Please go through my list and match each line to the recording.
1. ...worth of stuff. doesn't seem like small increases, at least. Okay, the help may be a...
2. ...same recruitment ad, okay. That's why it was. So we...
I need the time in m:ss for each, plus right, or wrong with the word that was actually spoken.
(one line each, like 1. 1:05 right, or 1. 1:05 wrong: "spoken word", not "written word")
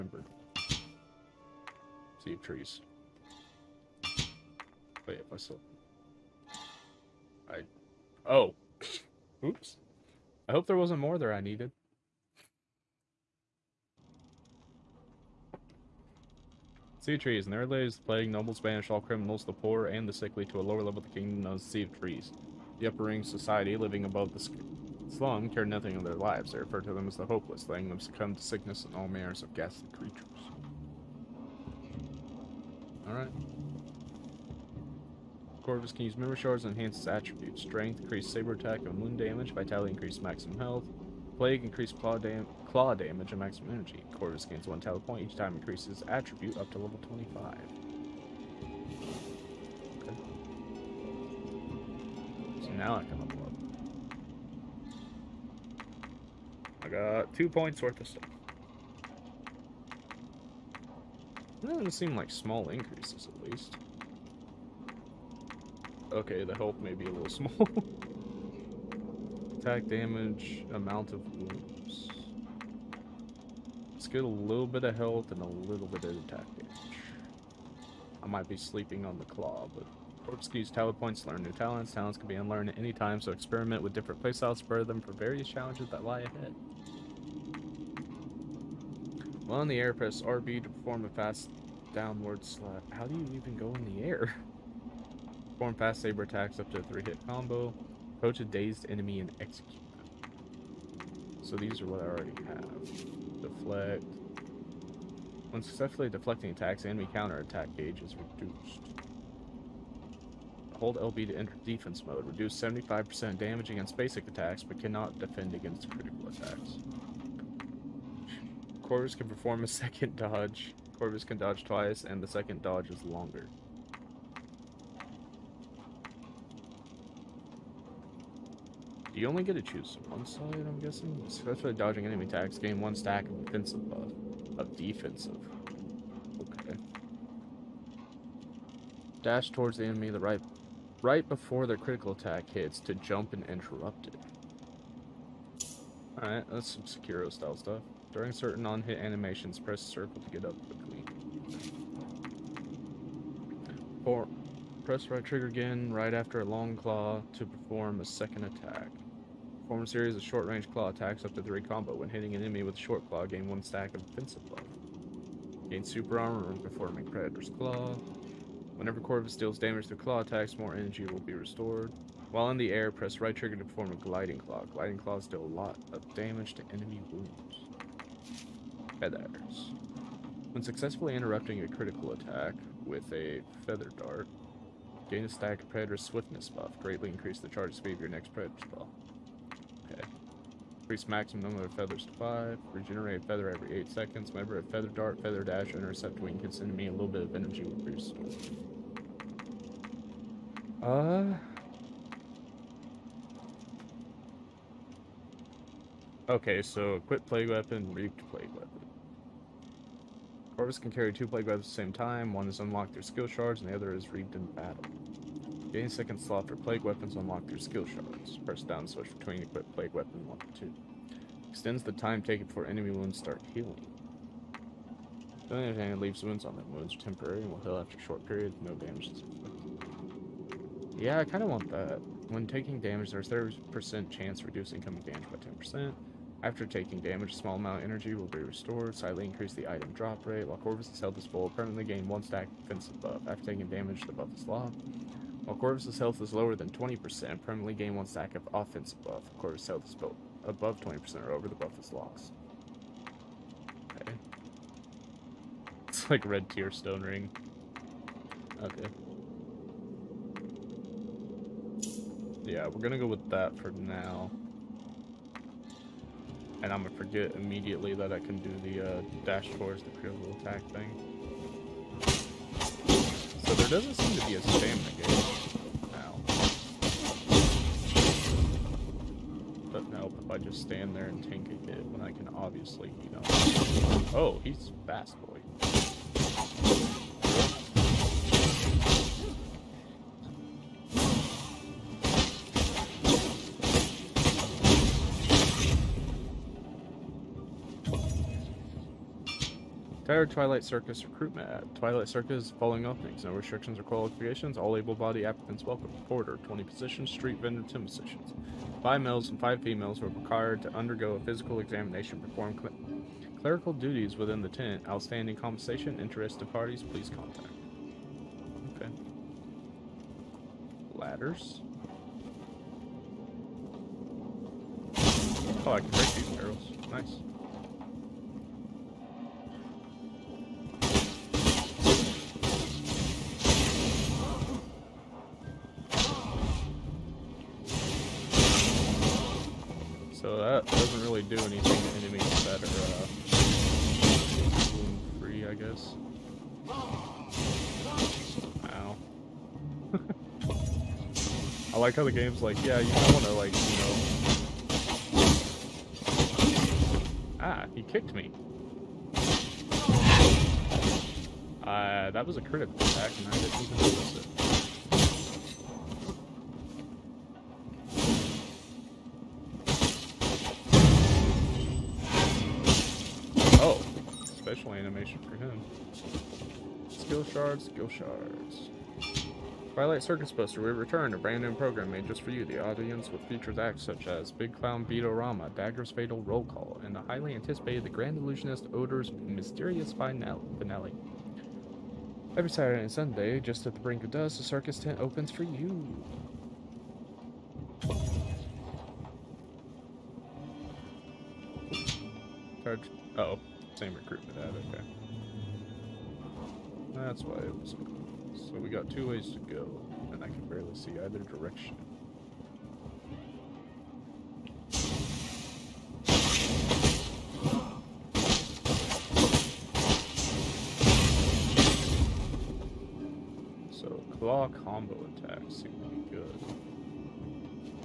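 1. 0:57 right
2. 6:43 right.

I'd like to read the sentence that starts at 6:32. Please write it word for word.
Every Saturday and Sunday, just at the brink of dusk, the circus tent opens for you.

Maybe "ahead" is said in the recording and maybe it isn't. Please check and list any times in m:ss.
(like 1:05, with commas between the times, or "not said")
1:26.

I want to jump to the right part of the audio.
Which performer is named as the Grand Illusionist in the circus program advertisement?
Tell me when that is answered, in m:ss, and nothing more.
6:28.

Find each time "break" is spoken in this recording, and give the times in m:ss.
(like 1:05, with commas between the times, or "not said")
5:25.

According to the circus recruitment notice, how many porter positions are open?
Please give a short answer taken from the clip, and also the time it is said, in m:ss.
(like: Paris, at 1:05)
20, at 5:06.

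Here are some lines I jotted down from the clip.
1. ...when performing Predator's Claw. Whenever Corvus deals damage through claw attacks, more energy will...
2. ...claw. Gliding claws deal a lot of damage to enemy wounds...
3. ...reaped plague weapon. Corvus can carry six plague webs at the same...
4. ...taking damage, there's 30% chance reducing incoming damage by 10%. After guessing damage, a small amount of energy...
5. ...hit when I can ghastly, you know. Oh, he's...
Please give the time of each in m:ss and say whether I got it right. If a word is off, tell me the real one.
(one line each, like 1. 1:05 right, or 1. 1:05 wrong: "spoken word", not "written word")
1. 2:46 right
2. 2:54 right
3. 3:27 wrong: "two", not "six"
4. 3:52 wrong: "taking", not "guessing"
5. 4:41 wrong: "obviously", not "ghastly".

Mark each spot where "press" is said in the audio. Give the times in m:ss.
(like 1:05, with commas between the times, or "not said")
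1:29, 2:29, 2:34, 2:52, 3:38.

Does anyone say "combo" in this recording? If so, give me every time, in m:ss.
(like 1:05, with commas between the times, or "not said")
1:37, 2:41, 7:04.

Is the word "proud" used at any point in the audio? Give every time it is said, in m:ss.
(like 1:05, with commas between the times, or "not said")
not said.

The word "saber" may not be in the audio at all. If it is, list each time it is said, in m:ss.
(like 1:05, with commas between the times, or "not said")
0:38, 1:36.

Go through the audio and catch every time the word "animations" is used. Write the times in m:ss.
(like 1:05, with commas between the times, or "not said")
2:28, 6:14.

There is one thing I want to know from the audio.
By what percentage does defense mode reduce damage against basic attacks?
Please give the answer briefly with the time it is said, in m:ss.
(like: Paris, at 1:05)
75%, at 1:52.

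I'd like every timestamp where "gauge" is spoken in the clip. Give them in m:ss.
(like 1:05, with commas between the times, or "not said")
1:47, 4:34.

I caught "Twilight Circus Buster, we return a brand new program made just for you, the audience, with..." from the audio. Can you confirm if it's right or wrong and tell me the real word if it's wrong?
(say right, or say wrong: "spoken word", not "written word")
right.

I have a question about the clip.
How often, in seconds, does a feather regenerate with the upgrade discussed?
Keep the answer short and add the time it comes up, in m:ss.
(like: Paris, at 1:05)
8, at 3:13.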